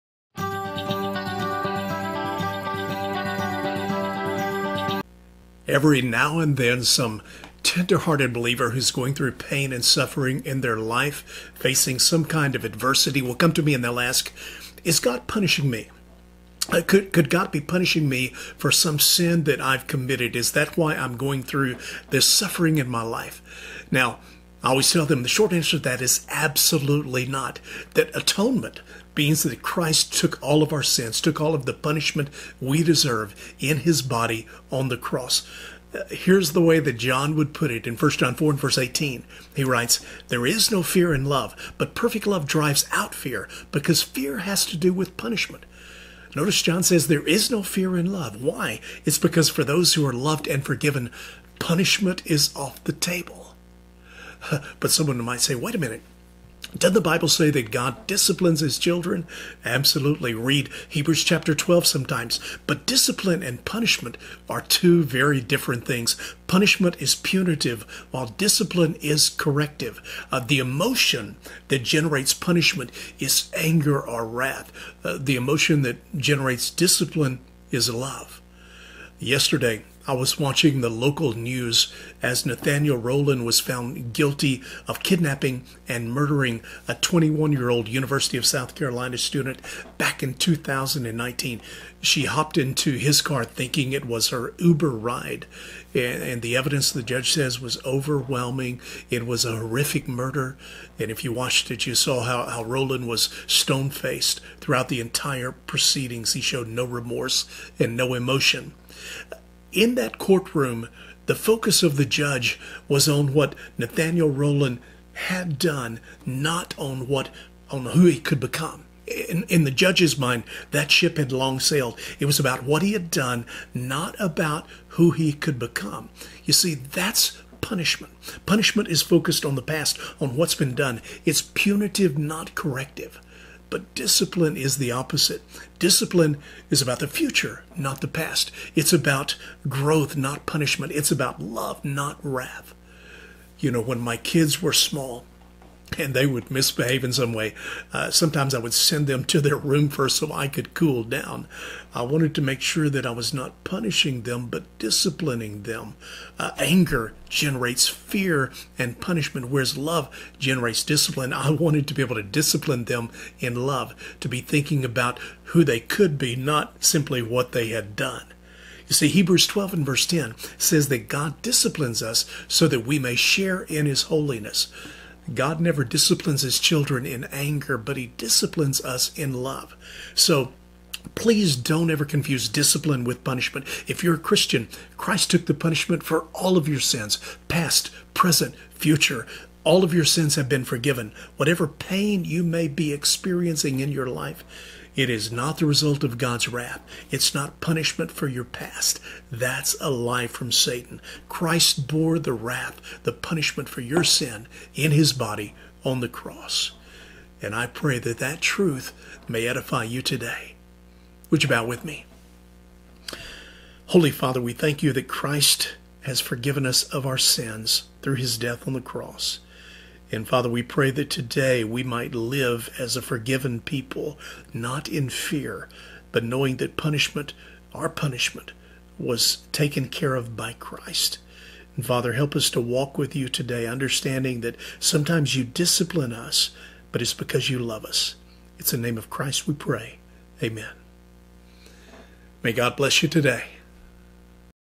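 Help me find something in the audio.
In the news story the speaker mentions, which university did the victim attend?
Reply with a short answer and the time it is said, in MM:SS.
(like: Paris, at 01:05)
University of South Carolina, at 01:27.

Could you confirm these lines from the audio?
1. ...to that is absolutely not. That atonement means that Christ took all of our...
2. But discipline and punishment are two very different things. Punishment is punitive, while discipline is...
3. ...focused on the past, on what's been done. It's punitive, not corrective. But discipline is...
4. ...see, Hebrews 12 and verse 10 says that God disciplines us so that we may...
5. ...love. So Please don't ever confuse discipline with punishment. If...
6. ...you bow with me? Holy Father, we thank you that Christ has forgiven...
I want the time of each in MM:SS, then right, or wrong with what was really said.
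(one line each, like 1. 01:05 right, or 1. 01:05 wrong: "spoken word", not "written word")
1. 00:25 right
2. 01:02 right
3. 02:09 right
4. 02:48 right
5. 02:59 right
6. 03:31 right.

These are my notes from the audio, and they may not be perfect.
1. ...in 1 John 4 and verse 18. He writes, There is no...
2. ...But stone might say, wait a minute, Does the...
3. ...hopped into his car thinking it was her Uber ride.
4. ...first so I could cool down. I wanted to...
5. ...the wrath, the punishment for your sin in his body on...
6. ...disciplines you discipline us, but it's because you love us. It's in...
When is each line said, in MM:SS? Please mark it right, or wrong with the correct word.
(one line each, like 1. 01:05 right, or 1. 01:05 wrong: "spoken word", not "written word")
1. 00:37 right
2. 00:54 wrong: "someone", not "stone"
3. 01:32 right
4. 02:29 right
5. 03:22 right
6. 03:54 wrong: "sometimes", not "disciplines".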